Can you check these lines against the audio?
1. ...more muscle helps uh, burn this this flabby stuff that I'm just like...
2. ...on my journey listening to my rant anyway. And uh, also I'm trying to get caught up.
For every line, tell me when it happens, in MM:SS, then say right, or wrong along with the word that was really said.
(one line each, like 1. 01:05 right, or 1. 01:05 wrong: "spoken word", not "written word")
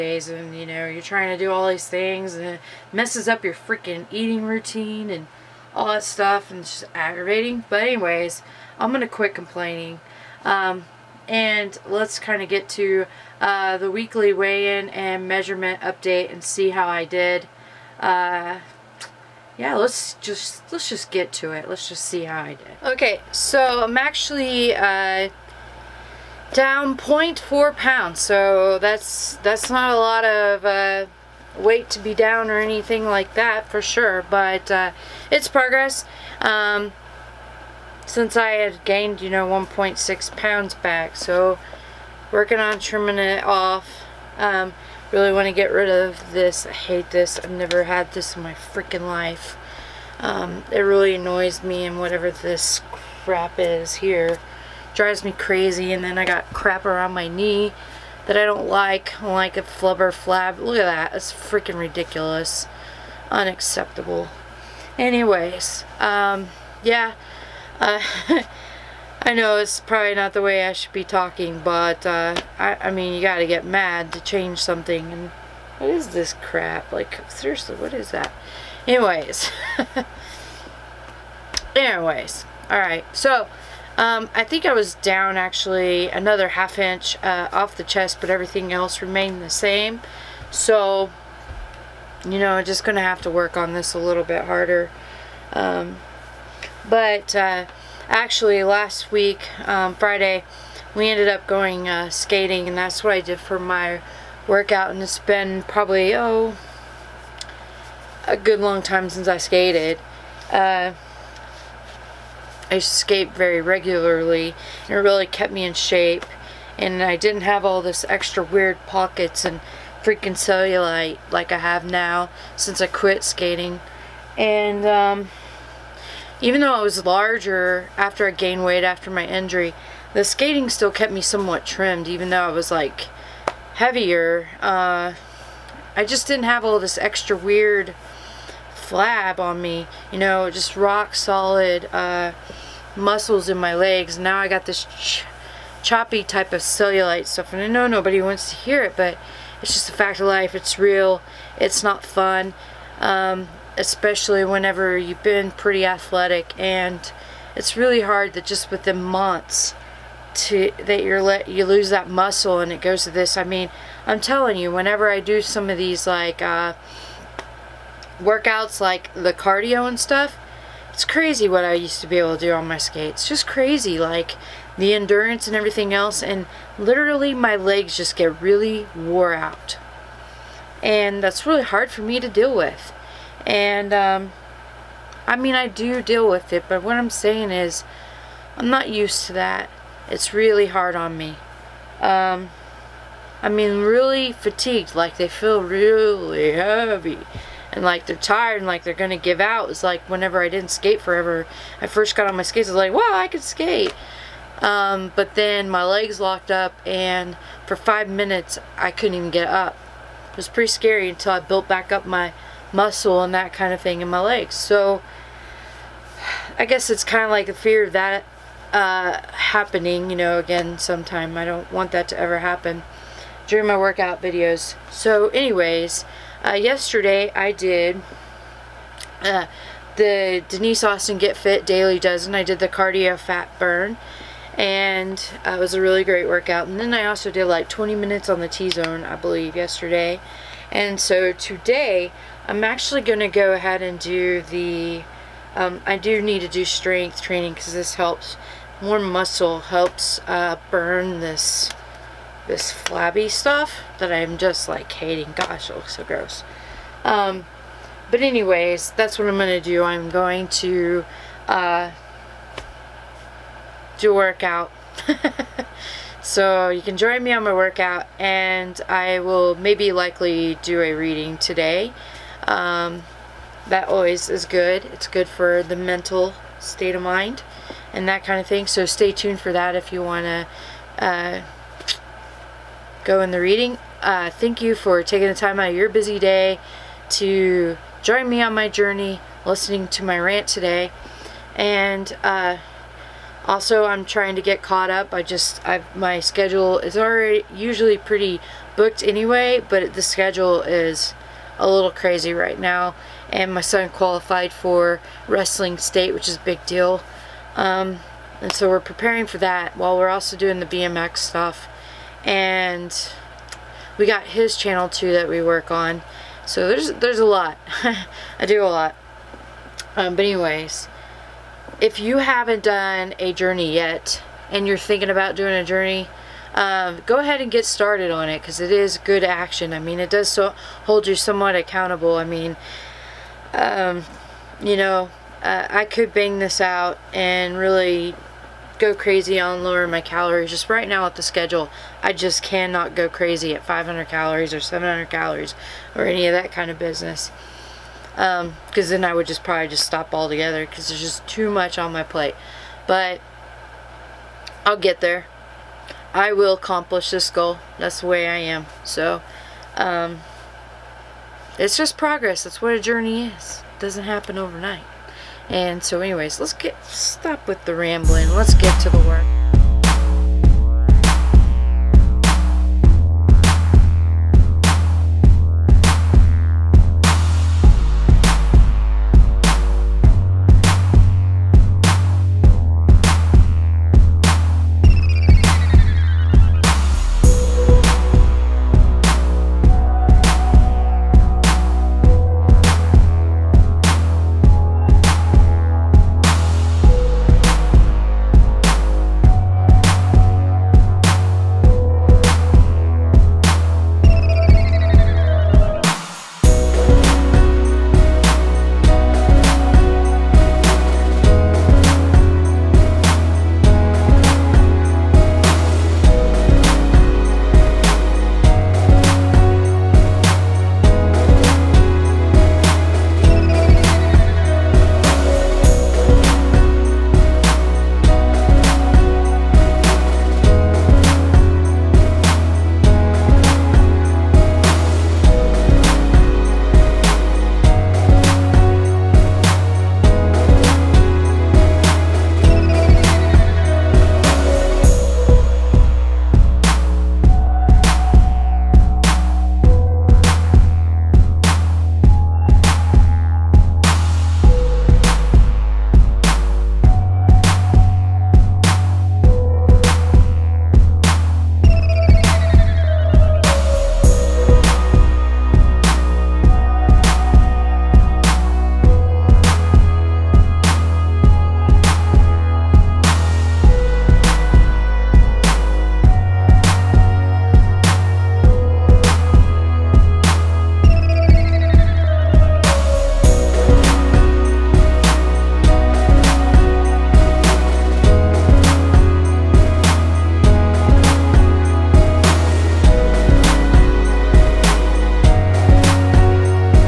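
1. 04:08 right
2. 04:48 wrong: "today", not "anyway".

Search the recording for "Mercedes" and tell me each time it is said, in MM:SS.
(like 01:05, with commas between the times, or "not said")
not said.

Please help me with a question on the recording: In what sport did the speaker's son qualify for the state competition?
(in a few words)
wrestling.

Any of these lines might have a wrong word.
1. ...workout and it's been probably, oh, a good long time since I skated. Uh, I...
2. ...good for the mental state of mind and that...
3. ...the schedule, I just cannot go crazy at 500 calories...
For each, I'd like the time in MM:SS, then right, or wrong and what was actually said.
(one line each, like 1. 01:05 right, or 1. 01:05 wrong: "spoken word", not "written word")
1. 01:44 right
2. 04:35 right
3. 05:41 right.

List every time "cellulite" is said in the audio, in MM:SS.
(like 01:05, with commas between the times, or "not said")
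02:00, 02:26.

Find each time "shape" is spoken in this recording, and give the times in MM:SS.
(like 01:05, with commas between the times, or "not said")
01:55.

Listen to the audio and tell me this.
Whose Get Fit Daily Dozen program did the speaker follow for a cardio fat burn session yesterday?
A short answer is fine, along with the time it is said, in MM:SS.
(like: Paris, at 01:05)
Denise Austin, at 03:50.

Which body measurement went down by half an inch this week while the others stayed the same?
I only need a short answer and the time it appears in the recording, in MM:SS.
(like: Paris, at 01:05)
chest, at 01:27.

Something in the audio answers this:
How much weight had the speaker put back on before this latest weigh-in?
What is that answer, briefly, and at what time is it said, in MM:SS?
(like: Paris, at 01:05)
1.6 pounds, at 00:39.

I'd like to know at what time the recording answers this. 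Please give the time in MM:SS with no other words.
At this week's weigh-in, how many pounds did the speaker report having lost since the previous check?
00:26.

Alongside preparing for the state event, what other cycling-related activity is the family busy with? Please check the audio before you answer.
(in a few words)
BMX.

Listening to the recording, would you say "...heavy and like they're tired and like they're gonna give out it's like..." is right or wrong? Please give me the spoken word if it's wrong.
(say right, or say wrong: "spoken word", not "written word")
right.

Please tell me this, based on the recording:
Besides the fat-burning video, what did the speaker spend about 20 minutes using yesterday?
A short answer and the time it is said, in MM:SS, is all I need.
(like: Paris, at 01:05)
T-zone, at 03:58.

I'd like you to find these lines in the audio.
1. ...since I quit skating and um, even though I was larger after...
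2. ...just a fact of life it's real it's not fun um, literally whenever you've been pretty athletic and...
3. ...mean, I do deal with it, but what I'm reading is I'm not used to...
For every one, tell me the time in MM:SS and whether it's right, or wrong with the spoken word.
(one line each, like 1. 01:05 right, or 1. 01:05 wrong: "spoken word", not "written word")
1. 02:02 right
2. 02:29 wrong: "especially", not "literally"
3. 03:05 wrong: "saying", not "reading".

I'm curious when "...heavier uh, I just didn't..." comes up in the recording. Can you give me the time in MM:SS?
02:13.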